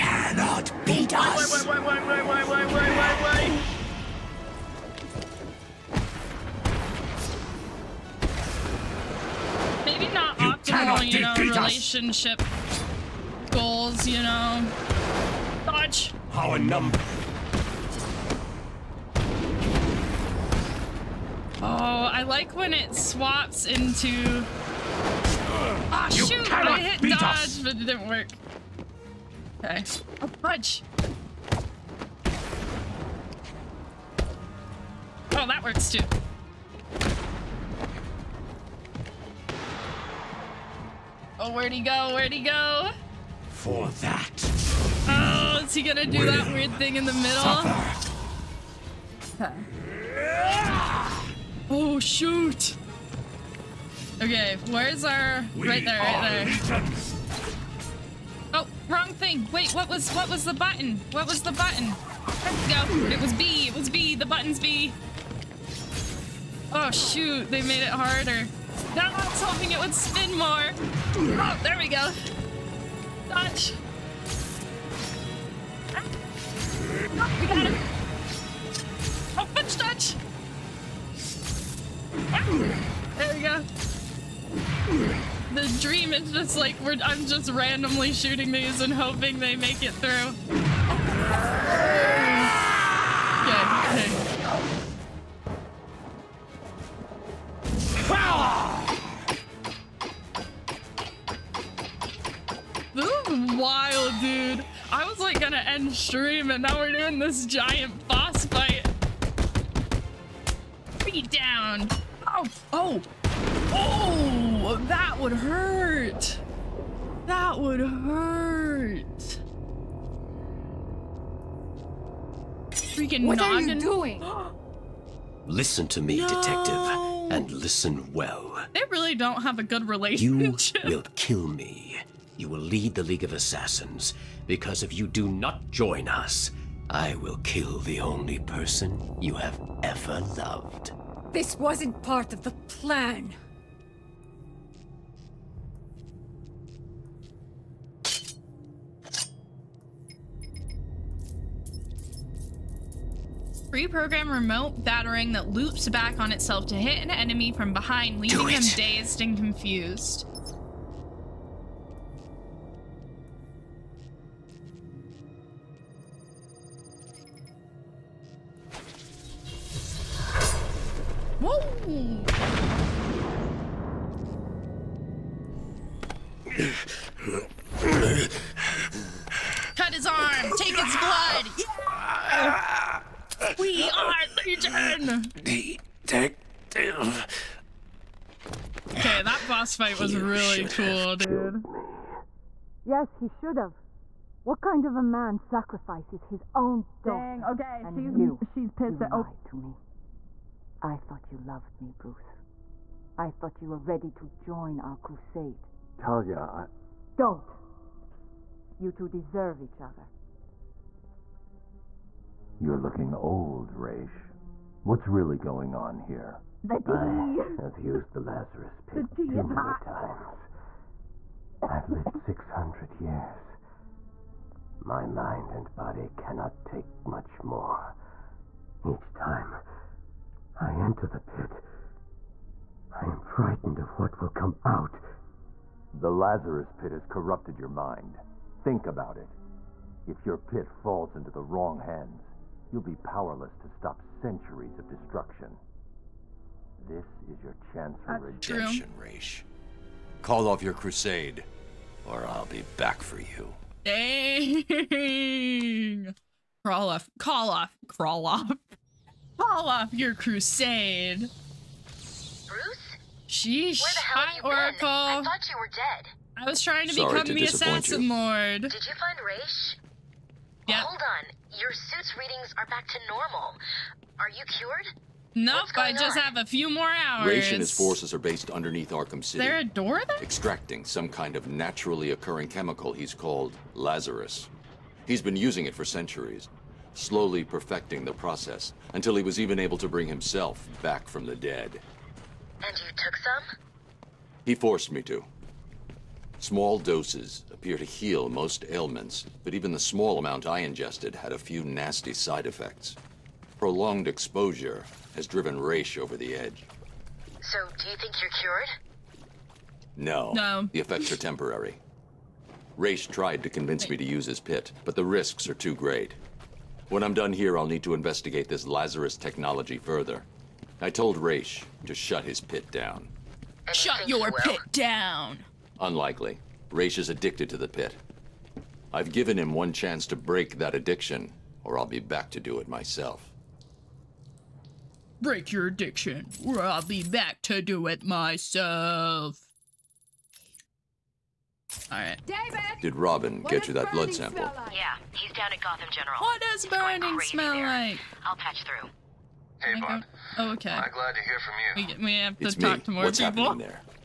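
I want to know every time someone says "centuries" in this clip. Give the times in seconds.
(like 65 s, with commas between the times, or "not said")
244 s, 285 s.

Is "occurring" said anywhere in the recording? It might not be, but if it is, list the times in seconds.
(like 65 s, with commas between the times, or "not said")
282 s.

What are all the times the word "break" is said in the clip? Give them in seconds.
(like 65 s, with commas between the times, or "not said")
330 s, 335 s.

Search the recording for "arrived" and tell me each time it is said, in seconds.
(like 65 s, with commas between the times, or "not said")
not said.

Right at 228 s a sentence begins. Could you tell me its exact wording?
Each time I enter the pit, I am frightened of what will come out.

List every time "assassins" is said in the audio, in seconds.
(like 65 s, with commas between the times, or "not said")
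133 s, 267 s.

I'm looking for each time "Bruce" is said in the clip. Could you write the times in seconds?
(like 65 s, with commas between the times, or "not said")
201 s, 261 s.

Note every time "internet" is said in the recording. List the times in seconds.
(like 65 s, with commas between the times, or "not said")
not said.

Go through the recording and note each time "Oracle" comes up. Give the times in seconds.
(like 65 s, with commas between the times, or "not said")
264 s.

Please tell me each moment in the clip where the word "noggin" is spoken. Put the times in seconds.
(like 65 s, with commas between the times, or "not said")
123 s.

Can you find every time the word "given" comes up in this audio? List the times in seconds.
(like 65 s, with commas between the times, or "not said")
329 s.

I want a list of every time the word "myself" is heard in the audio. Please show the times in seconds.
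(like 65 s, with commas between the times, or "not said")
332 s, 338 s.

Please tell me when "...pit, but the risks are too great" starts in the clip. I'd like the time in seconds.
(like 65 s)
314 s.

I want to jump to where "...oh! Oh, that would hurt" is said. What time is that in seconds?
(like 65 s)
113 s.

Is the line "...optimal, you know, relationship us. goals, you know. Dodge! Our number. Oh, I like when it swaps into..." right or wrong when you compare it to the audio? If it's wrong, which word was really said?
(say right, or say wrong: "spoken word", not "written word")
right.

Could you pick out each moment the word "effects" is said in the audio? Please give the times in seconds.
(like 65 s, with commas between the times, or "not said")
302 s, 310 s.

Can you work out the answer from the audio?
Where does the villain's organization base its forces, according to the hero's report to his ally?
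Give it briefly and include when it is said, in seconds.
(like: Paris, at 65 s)
Underneath Arkham City, at 278 s.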